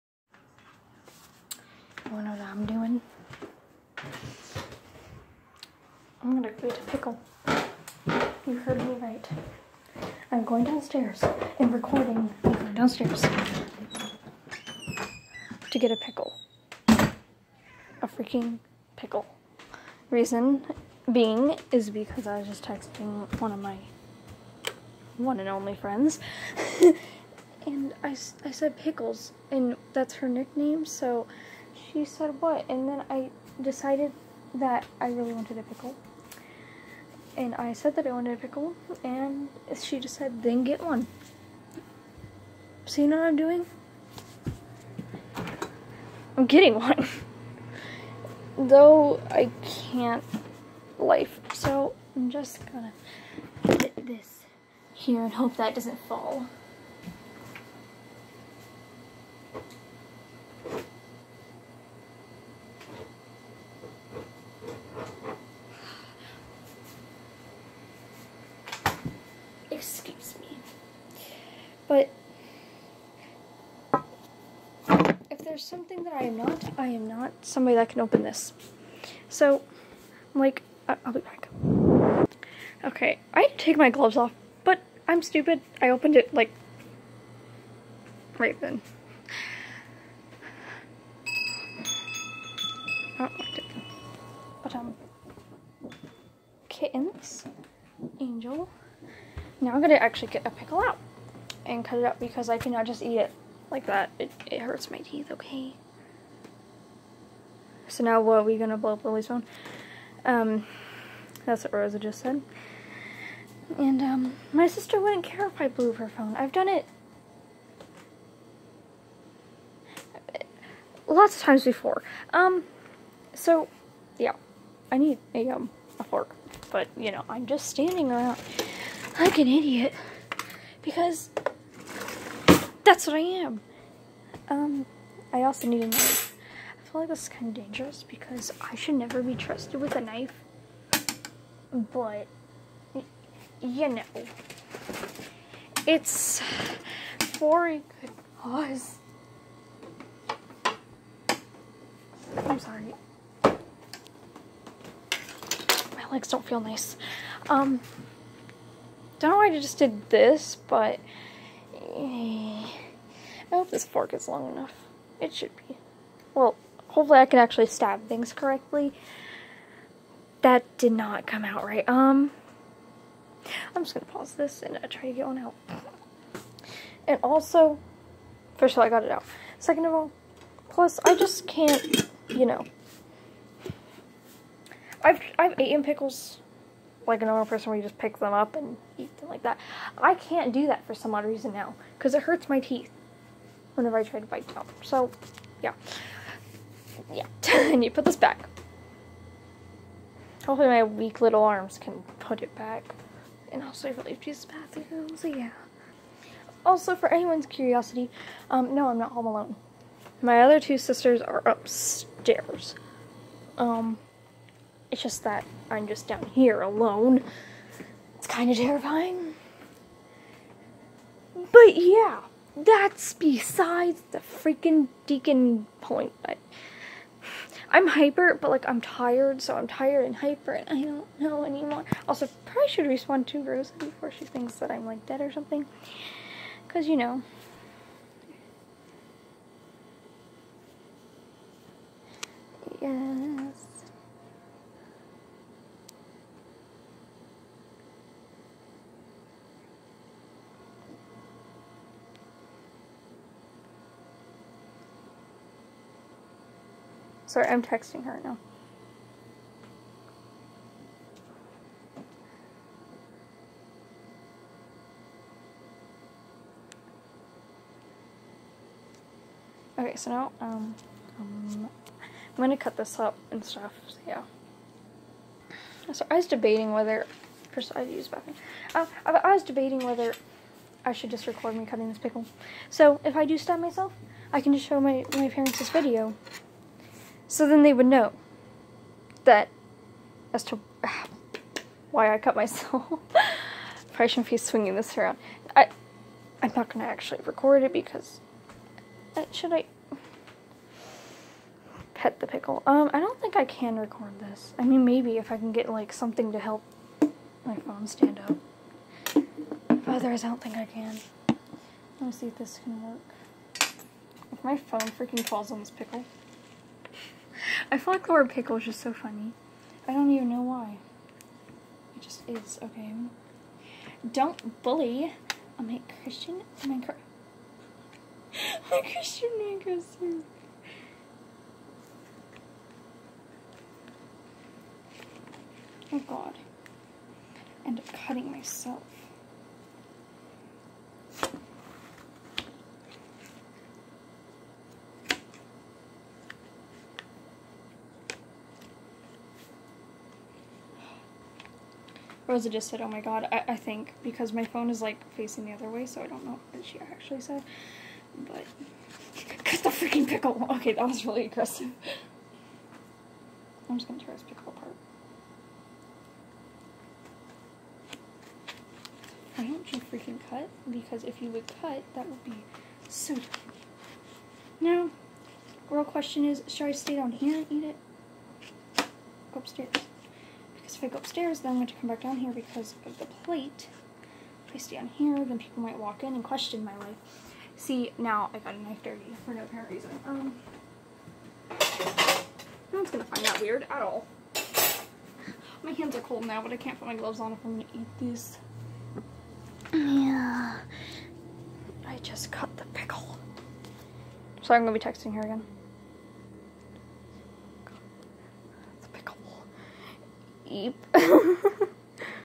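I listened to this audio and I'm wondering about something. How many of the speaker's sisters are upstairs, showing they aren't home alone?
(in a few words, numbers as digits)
2.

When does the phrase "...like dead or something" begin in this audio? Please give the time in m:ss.
3:54.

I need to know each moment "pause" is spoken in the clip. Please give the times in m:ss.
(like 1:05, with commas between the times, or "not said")
2:54.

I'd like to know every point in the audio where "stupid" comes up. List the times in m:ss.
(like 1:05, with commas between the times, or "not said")
1:25.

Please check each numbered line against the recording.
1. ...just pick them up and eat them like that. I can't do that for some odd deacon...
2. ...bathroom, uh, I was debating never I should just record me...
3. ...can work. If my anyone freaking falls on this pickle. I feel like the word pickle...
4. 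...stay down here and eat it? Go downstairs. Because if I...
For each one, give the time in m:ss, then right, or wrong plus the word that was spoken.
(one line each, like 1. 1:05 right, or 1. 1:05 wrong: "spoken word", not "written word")
1. 3:07 wrong: "reason", not "deacon"
2. 4:38 wrong: "whether", not "never"
3. 5:12 wrong: "phone", not "anyone"
4. 6:16 wrong: "upstairs", not "downstairs".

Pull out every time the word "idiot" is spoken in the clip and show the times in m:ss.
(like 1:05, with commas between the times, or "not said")
2:09.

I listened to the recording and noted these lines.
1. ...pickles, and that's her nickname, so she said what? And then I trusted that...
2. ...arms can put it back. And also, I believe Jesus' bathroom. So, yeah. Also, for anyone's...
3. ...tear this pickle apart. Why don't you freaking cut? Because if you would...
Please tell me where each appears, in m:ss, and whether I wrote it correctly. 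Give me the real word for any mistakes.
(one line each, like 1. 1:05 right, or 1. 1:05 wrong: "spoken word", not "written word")
1. 0:28 wrong: "decided", not "trusted"
2. 3:21 right
3. 6:04 right.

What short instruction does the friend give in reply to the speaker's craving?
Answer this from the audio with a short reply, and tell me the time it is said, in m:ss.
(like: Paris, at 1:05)
then get one, at 0:40.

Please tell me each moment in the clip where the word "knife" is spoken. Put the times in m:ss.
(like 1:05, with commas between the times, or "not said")
2:15, 2:20, 6:28.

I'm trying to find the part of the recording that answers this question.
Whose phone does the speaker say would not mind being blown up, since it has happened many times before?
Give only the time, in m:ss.
1:49.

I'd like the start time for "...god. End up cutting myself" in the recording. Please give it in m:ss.
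5:36.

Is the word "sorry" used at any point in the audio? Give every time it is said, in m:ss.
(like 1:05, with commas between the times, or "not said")
2:32, 4:17.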